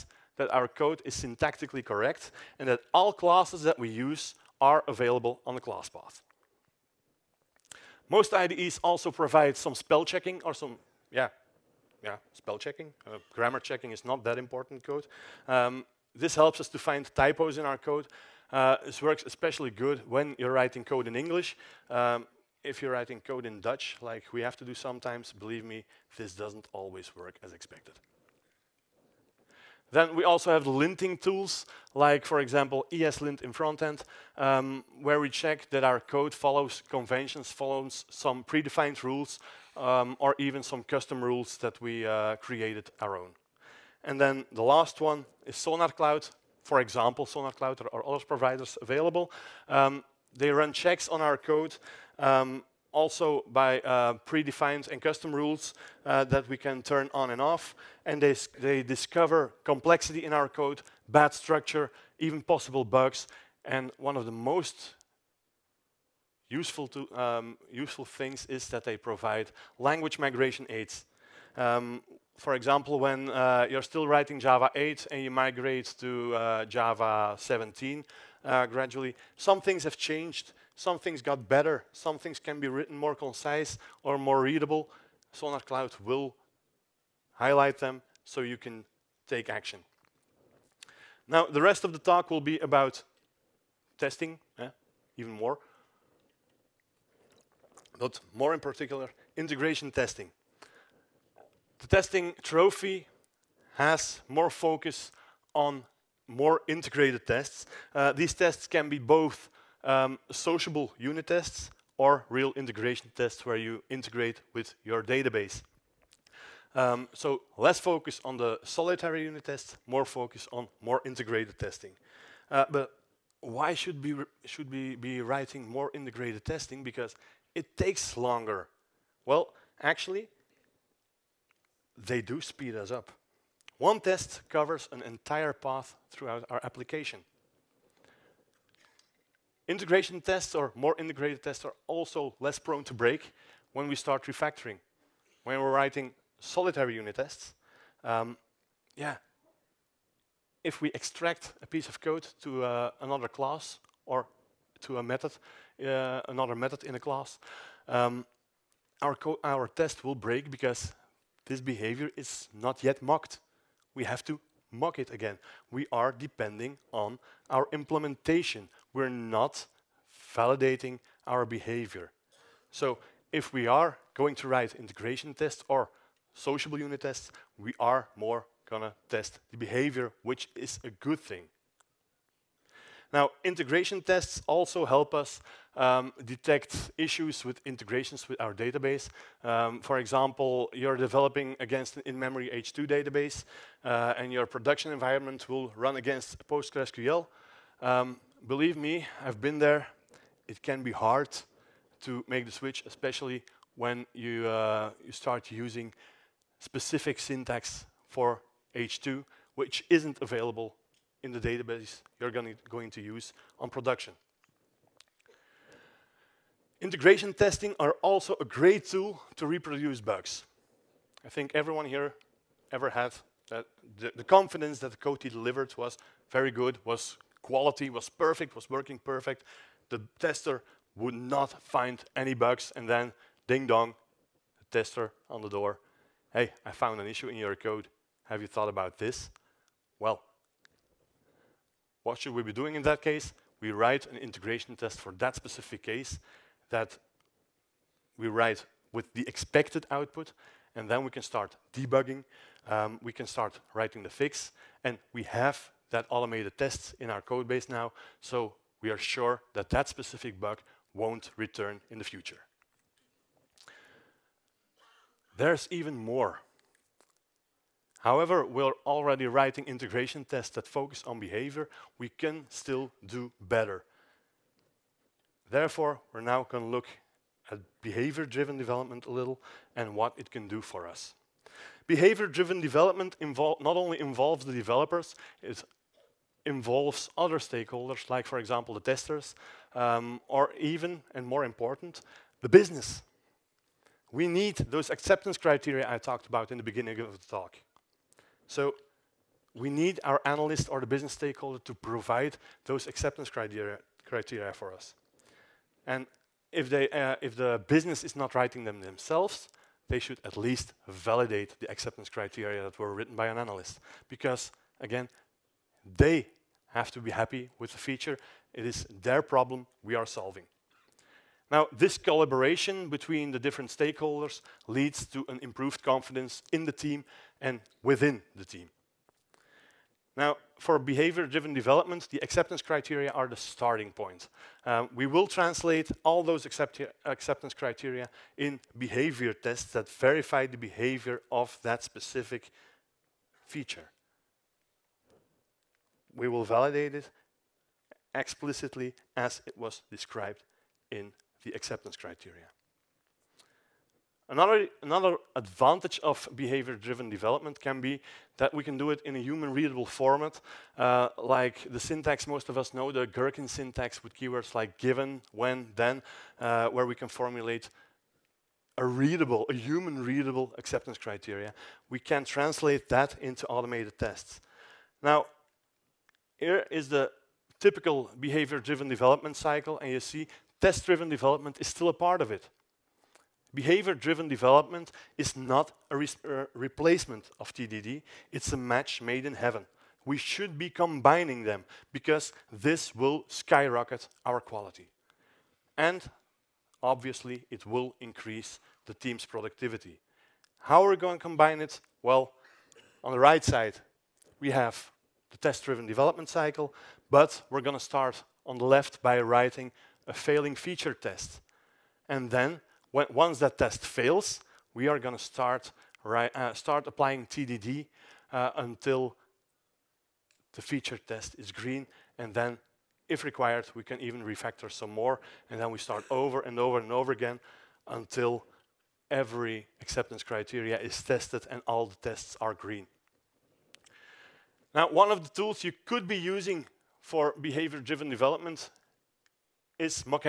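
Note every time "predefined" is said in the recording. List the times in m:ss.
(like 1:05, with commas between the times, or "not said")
0:38, 0:54.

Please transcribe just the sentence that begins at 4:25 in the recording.
There's even more However, we're already writing integration tests that focus on behavior.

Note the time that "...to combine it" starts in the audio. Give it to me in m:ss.
6:41.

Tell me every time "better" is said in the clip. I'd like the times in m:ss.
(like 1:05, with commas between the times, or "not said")
1:21, 4:33.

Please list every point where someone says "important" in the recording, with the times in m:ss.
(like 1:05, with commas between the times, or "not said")
0:14, 4:51.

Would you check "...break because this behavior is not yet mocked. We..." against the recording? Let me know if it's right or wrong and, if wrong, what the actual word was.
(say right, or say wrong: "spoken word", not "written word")
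right.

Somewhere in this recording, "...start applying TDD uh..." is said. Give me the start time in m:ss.
6:56.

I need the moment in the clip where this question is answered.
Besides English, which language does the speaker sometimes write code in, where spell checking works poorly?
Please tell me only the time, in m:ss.
0:23.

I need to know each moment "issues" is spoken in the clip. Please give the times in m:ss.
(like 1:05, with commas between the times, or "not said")
3:06, 3:57.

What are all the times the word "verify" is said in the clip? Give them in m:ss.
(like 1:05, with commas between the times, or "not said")
5:39.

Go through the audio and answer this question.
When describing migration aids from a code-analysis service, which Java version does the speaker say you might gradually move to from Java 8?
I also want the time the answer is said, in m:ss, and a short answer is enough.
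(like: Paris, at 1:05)
Java 17, at 1:16.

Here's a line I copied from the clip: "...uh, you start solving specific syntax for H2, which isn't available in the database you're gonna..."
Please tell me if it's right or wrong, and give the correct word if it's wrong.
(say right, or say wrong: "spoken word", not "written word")
wrong: "using", not "solving".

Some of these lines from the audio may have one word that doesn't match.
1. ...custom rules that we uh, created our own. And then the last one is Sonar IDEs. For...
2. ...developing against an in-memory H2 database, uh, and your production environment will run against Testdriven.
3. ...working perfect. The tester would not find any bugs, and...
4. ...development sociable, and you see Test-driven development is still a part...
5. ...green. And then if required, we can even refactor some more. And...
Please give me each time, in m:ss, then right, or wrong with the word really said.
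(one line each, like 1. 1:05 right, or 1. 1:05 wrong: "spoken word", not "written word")
1. 0:40 wrong: "Cloud", not "IDEs"
2. 3:10 wrong: "PostgreSQL", not "Testdriven"
3. 3:48 right
4. 6:18 wrong: "cycle", not "sociable"
5. 7:01 right.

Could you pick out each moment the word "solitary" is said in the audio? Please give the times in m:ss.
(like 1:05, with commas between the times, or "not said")
1:58, 2:26.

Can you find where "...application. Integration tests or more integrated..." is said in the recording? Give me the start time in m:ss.
2:16.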